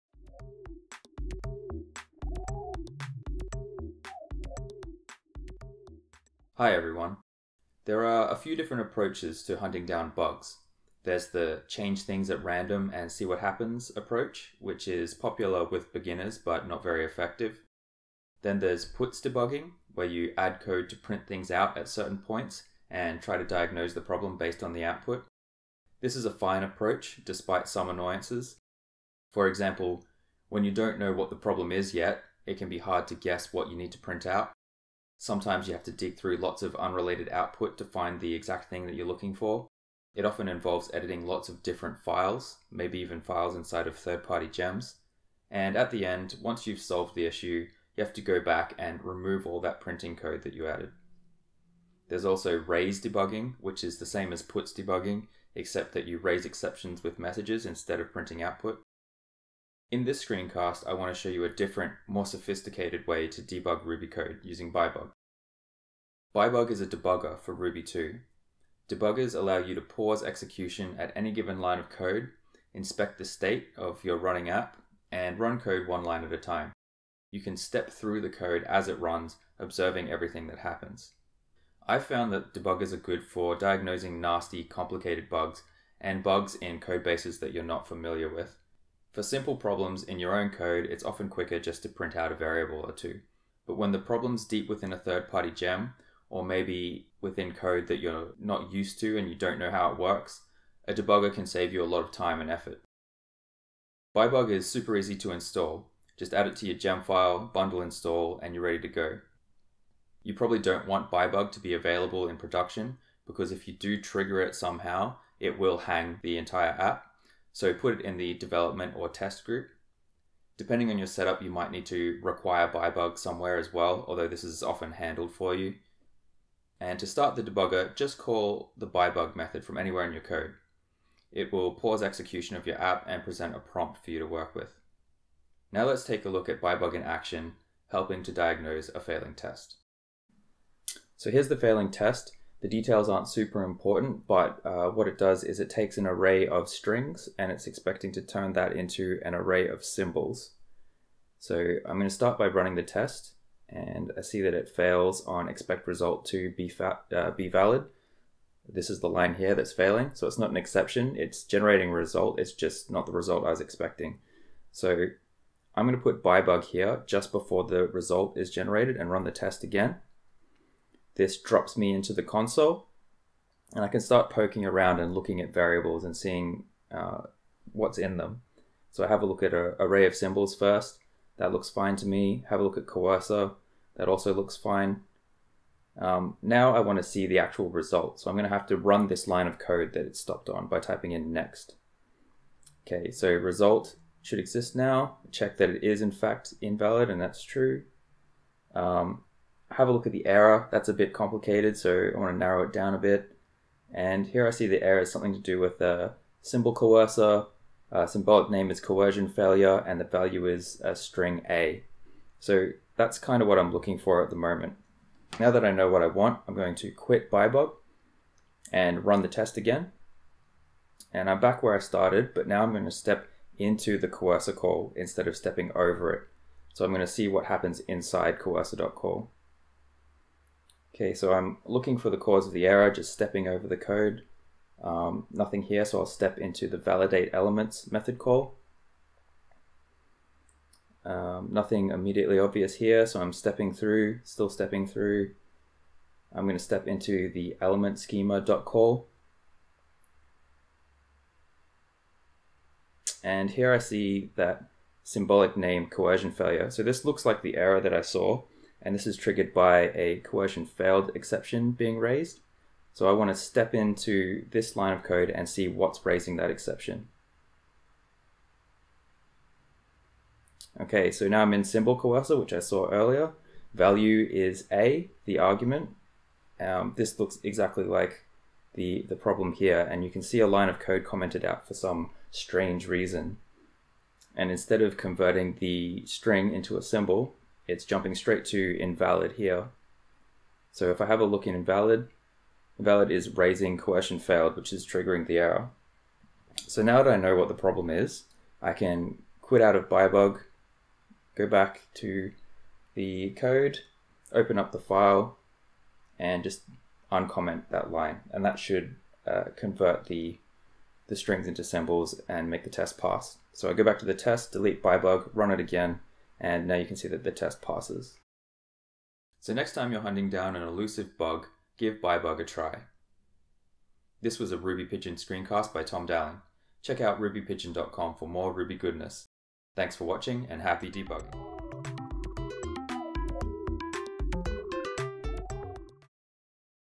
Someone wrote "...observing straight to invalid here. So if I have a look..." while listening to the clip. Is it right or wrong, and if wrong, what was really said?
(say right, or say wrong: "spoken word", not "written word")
wrong: "jumping", not "observing".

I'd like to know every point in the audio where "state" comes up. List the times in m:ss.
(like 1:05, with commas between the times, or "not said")
1:13.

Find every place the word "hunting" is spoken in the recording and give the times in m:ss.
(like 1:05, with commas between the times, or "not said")
0:09, 5:20.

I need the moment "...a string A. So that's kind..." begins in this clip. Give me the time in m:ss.
3:30.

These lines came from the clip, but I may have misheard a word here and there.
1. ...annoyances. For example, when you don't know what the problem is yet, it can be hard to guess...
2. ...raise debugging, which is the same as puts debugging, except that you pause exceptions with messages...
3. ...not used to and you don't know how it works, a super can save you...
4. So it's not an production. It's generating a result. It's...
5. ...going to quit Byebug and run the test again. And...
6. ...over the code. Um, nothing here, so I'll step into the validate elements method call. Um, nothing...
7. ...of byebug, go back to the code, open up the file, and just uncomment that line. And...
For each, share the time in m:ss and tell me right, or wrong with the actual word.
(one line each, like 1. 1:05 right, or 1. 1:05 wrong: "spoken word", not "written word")
1. 0:27 right
2. 0:52 wrong: "raise", not "pause"
3. 1:38 wrong: "debugger", not "super"
4. 2:40 wrong: "exception", not "production"
5. 3:36 right
6. 3:53 right
7. 4:59 right.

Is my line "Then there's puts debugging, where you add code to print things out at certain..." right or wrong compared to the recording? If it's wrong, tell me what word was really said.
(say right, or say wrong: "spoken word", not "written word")
right.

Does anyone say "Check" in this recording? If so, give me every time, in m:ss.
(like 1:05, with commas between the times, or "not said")
3:15, 5:26.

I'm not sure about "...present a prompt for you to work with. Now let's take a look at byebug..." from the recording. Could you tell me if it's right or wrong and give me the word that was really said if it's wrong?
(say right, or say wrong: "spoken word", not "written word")
right.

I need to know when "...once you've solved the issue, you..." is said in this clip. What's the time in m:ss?
0:46.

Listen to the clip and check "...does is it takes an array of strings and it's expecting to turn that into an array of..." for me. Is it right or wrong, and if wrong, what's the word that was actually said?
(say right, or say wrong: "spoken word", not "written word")
right.